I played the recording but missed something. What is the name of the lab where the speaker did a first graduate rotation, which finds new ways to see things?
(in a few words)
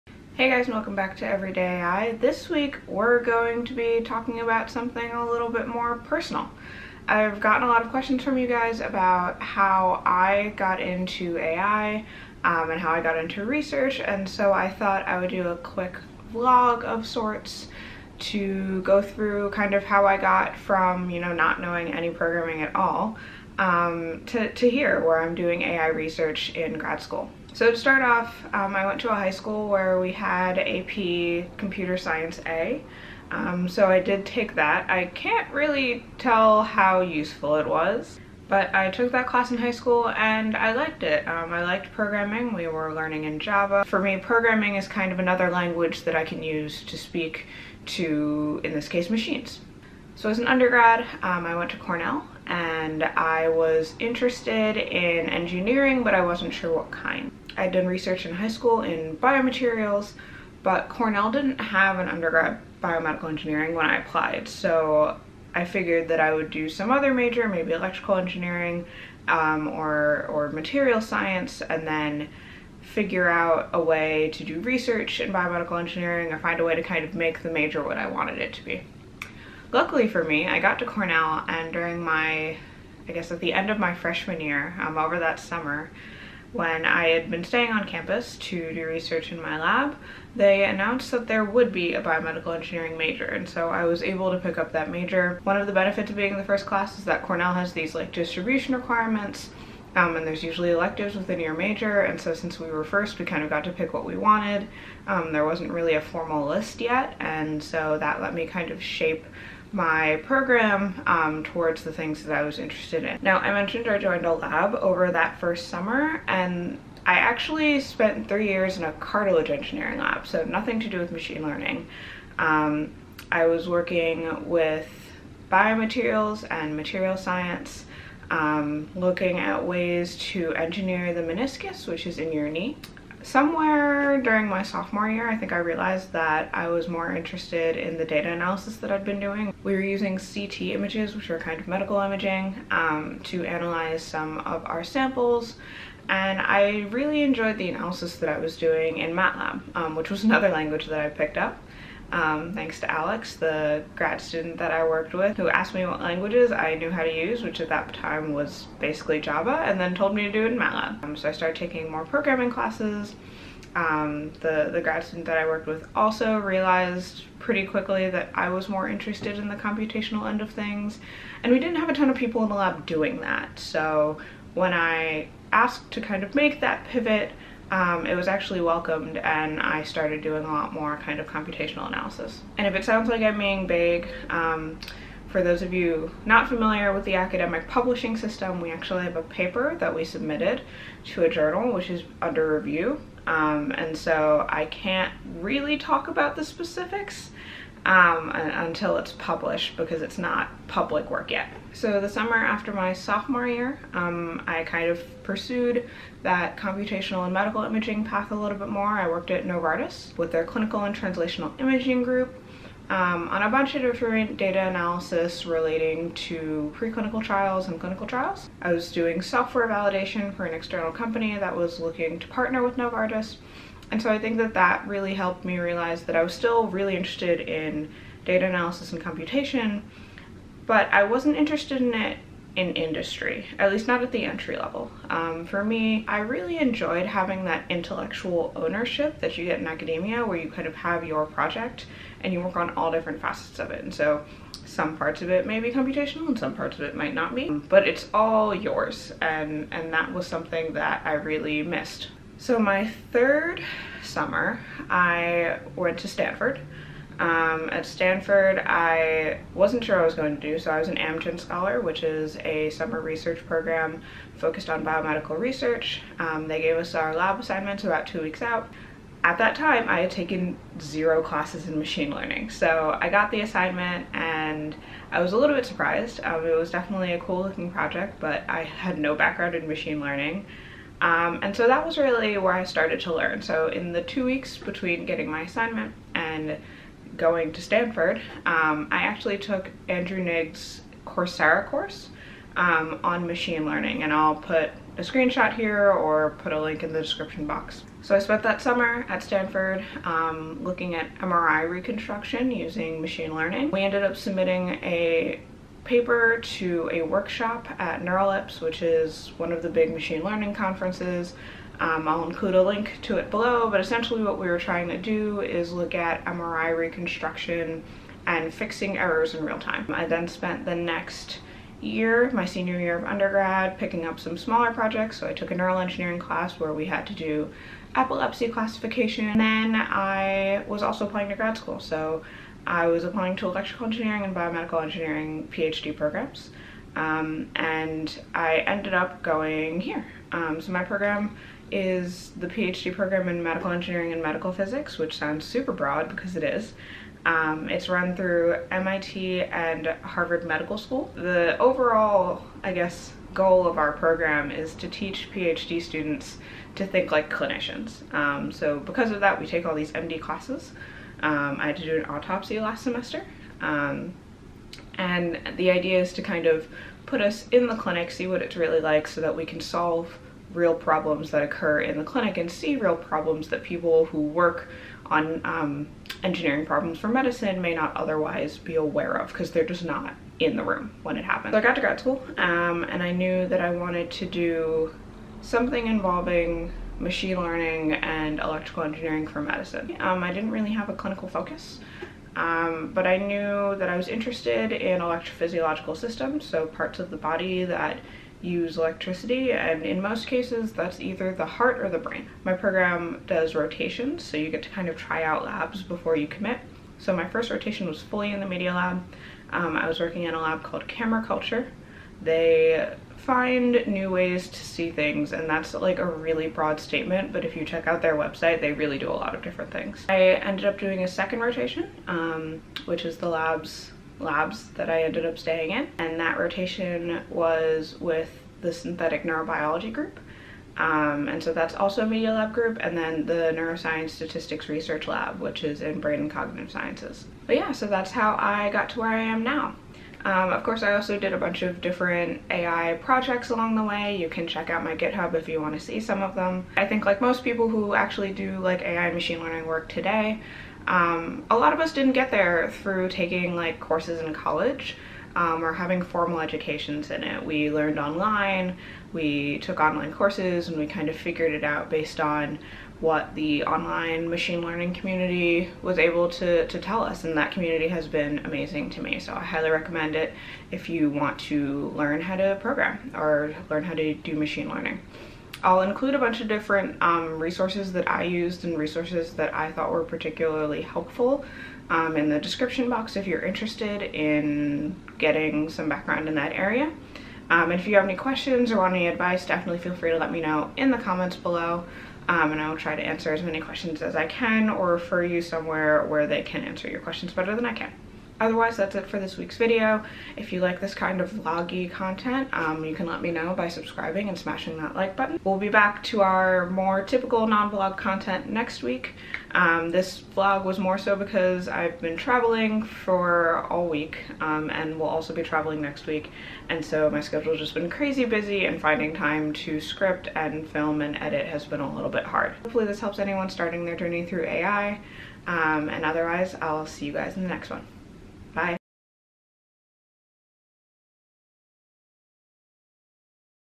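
Camera Culture.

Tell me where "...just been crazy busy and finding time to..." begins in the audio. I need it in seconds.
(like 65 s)
517 s.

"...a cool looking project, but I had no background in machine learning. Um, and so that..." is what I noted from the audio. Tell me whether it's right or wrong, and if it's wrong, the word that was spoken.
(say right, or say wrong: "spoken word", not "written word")
right.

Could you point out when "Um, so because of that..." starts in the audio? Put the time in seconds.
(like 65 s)
358 s.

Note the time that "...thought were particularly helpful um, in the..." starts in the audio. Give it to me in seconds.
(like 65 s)
479 s.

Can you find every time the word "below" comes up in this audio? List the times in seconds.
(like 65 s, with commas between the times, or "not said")
313 s, 491 s.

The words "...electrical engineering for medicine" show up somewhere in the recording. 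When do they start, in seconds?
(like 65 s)
388 s.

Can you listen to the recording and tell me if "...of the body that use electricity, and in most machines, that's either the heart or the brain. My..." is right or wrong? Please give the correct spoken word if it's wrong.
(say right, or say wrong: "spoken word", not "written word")
wrong: "cases", not "machines".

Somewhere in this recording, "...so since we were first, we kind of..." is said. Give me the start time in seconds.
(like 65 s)
102 s.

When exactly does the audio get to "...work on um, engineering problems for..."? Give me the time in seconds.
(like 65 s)
374 s.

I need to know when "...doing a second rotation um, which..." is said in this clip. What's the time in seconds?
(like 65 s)
420 s.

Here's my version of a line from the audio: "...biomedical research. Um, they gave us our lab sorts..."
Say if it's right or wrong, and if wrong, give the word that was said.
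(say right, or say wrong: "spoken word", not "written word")
wrong: "assignments", not "sorts".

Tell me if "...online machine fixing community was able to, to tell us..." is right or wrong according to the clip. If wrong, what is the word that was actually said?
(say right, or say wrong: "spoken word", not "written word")
wrong: "learning", not "fixing".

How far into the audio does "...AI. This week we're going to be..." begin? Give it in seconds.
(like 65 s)
1 s.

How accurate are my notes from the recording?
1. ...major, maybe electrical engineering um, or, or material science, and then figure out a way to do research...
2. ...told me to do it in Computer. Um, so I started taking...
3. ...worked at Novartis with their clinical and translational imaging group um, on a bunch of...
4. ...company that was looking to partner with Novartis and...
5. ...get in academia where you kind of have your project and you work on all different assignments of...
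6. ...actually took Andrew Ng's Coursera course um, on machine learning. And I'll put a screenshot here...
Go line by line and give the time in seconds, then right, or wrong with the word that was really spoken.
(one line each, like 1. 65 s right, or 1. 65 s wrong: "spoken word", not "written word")
1. 67 s right
2. 159 s wrong: "MATLAB", not "Computer"
3. 209 s right
4. 220 s right
5. 239 s wrong: "facets", not "assignments"
6. 289 s right.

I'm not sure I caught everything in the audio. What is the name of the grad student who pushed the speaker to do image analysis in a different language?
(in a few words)
Alex.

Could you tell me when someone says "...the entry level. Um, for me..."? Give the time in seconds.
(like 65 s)
234 s.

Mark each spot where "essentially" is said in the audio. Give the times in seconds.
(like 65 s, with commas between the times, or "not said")
313 s.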